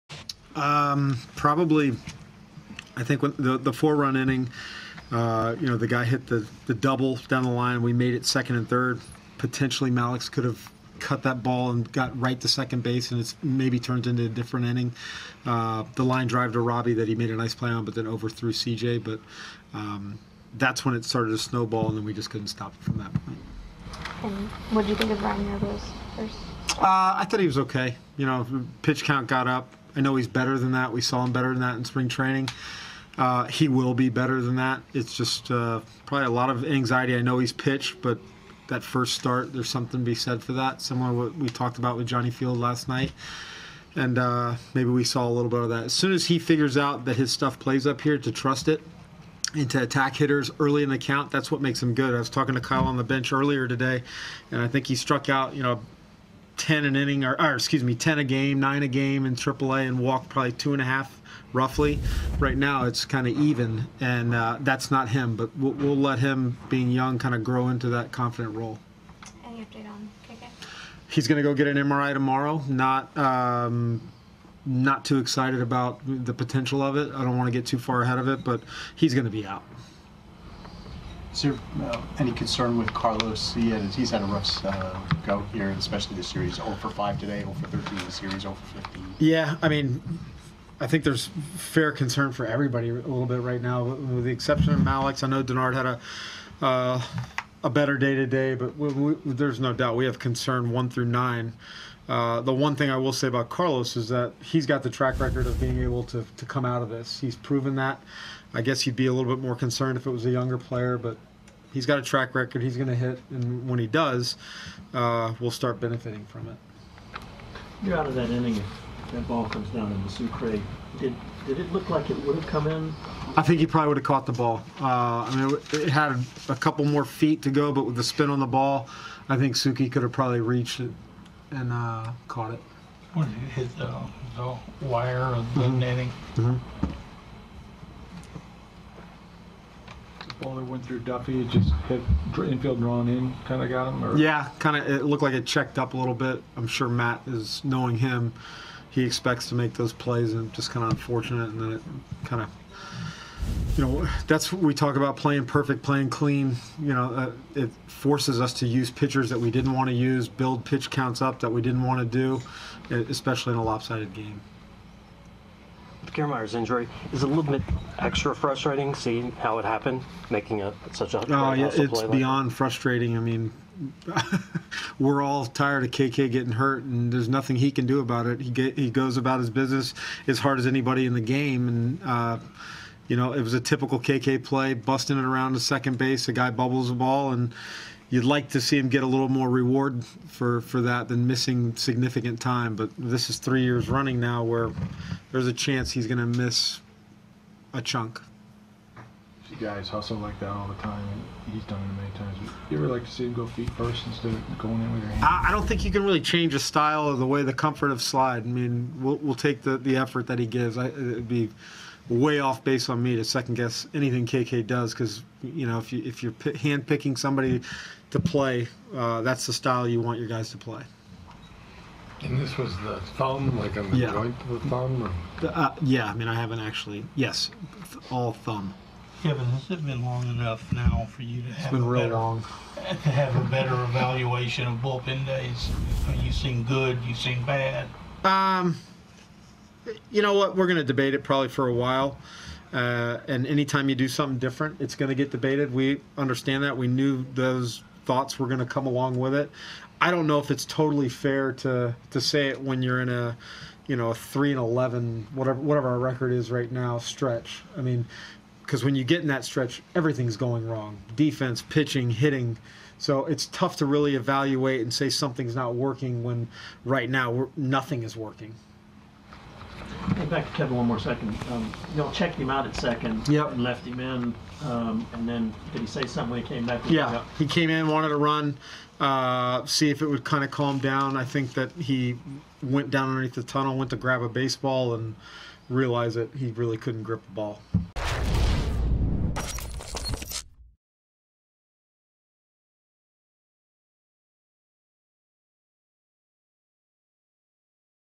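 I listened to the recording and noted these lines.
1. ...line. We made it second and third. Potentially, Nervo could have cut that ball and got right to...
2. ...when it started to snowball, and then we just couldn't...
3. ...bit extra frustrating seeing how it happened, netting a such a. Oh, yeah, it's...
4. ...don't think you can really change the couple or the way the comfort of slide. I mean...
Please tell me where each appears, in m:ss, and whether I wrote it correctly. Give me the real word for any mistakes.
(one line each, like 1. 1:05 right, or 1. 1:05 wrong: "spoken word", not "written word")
1. 0:07 wrong: "Mallex", not "Nervo"
2. 0:20 right
3. 2:47 wrong: "making", not "netting"
4. 3:25 wrong: "style", not "couple".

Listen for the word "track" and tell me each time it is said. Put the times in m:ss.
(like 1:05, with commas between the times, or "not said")
1:44, 1:52.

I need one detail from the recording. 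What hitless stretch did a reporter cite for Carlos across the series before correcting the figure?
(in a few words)
0 for 13.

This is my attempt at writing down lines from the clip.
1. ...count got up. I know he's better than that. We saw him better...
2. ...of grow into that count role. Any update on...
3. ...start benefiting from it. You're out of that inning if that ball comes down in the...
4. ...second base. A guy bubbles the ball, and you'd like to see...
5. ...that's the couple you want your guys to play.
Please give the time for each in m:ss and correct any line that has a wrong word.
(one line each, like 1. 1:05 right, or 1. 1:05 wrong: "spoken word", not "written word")
1. 0:29 right
2. 1:07 wrong: "confident", not "count"
3. 1:55 right
4. 3:05 right
5. 3:39 wrong: "style", not "couple".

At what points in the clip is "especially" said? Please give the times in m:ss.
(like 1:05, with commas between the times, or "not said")
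1:25, 2:43.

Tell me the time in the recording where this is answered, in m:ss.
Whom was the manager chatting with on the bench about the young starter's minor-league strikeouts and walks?
0:52.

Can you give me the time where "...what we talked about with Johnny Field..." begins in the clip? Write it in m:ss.
0:41.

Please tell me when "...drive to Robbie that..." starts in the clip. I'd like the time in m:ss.
0:16.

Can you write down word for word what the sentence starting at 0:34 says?
It's just uh, probably a lot of anxiety.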